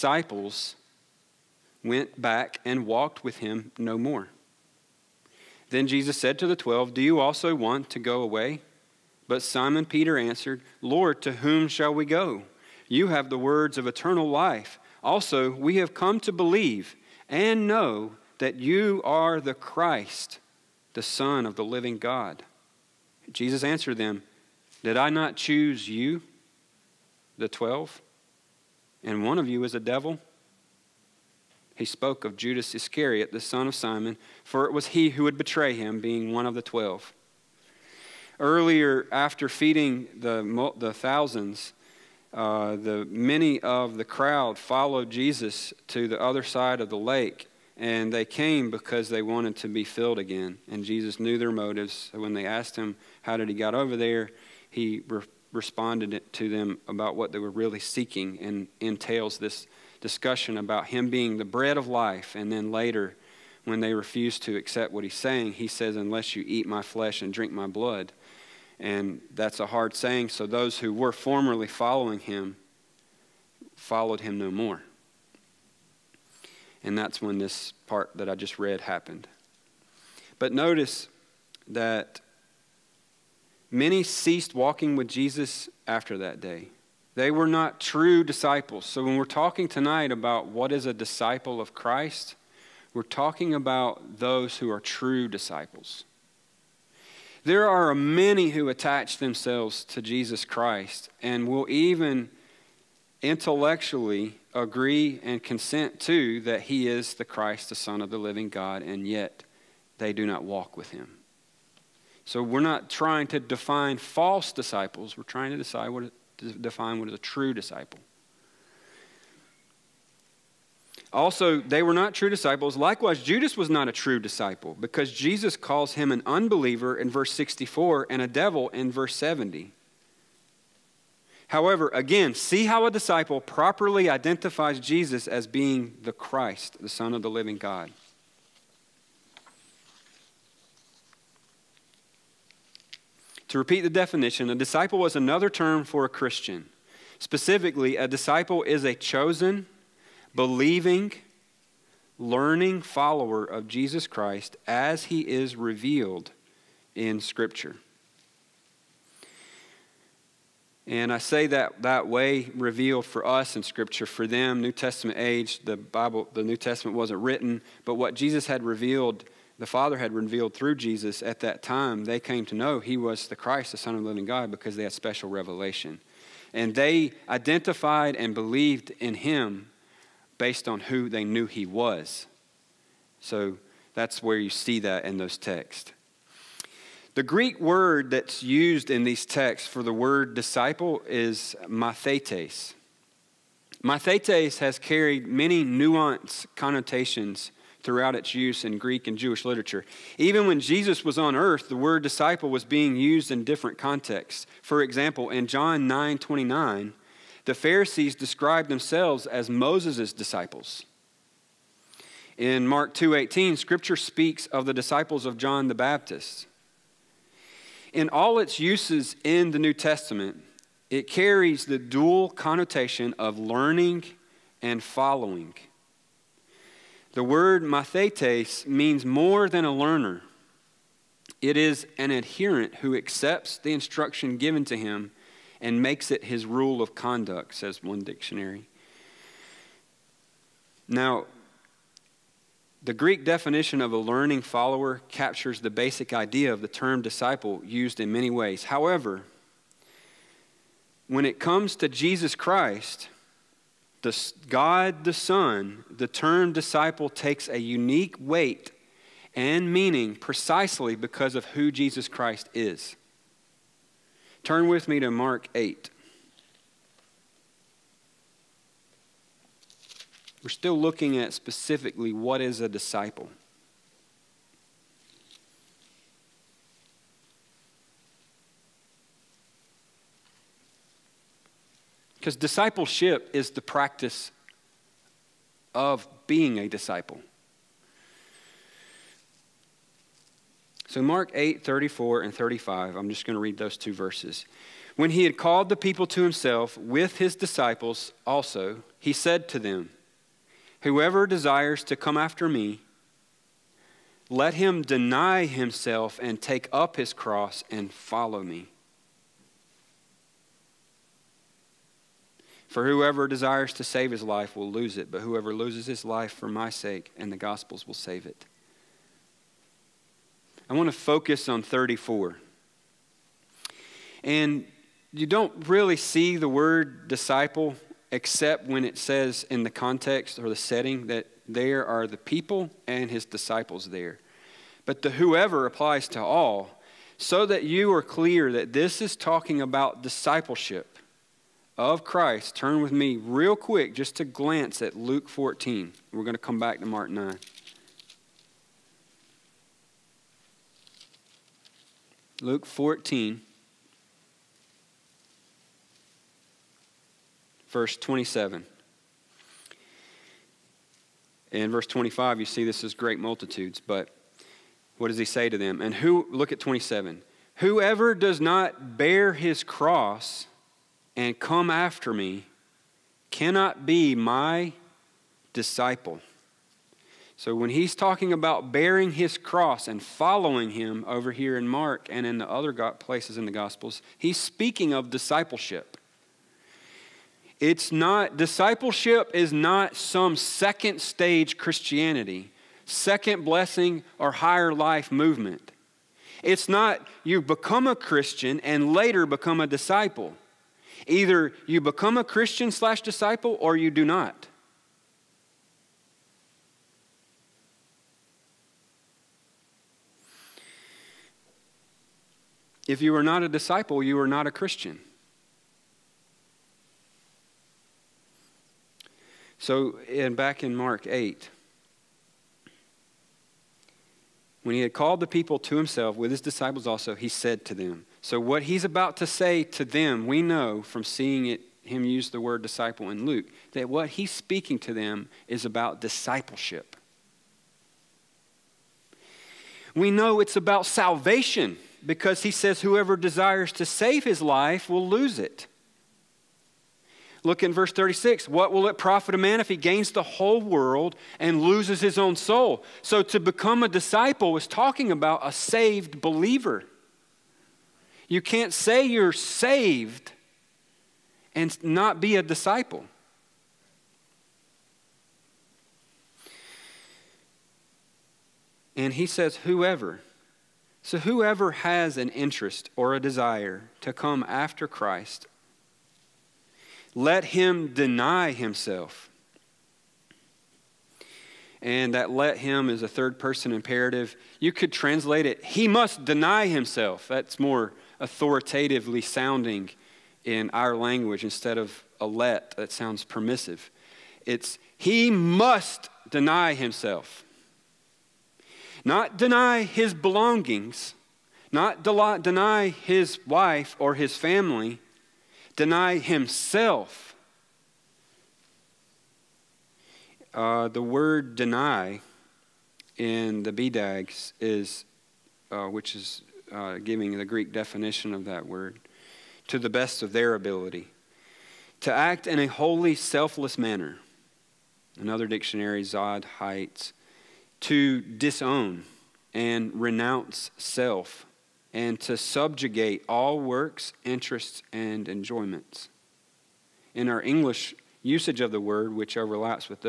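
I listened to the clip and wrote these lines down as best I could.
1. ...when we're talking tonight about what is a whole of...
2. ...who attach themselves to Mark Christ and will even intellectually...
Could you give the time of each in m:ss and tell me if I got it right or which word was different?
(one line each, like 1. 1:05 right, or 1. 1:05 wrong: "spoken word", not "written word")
1. 1:29 wrong: "disciple", not "whole"
2. 1:38 wrong: "Jesus", not "Mark".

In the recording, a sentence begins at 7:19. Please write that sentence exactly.
We know it's about salvation because he says, whoever desires to save his life will lose it.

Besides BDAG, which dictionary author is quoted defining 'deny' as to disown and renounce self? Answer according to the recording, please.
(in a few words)
Zodhiates.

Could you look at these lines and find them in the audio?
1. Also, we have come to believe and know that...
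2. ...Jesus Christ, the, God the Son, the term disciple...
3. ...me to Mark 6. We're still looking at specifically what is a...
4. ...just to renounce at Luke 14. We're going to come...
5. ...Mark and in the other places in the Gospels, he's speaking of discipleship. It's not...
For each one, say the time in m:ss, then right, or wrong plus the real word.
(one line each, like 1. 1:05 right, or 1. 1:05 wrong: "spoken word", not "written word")
1. 0:15 right
2. 4:11 right
3. 4:24 wrong: "8", not "6"
4. 5:43 wrong: "glance", not "renounce"
5. 6:21 right.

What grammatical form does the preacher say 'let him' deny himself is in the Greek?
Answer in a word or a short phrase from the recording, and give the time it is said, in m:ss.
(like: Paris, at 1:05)
third person imperative, at 8:03.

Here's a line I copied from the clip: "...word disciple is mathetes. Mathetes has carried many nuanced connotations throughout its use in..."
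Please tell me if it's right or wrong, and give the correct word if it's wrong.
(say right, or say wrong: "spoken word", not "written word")
right.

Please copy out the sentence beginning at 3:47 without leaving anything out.
The word mathetes means more than a learner.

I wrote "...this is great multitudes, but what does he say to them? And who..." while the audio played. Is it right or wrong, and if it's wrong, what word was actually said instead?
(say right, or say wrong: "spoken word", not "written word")
right.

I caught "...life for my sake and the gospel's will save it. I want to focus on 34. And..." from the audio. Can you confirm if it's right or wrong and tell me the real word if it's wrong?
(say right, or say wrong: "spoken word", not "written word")
right.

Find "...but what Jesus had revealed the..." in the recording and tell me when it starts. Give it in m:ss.
2:47.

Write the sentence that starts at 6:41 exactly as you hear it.
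Either you become a Christian slash disciple or you do not.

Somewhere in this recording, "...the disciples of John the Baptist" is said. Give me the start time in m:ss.
3:34.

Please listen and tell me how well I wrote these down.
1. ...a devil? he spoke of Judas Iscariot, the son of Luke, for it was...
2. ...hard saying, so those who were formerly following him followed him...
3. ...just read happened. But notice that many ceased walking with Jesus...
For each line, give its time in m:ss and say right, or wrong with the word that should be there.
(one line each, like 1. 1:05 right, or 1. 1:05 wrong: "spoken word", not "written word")
1. 0:29 wrong: "Simon", not "Luke"
2. 1:09 right
3. 1:18 right.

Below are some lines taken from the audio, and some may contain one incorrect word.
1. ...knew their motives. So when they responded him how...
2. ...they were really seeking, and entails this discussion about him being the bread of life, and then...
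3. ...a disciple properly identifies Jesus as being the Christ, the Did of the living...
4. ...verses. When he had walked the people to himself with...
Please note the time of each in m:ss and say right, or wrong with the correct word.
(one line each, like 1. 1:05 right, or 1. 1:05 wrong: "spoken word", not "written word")
1. 0:51 wrong: "asked", not "responded"
2. 0:57 right
3. 2:12 wrong: "Son", not "Did"
4. 4:53 wrong: "called", not "walked".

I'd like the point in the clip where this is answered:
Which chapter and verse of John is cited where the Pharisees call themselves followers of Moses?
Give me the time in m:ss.
3:25.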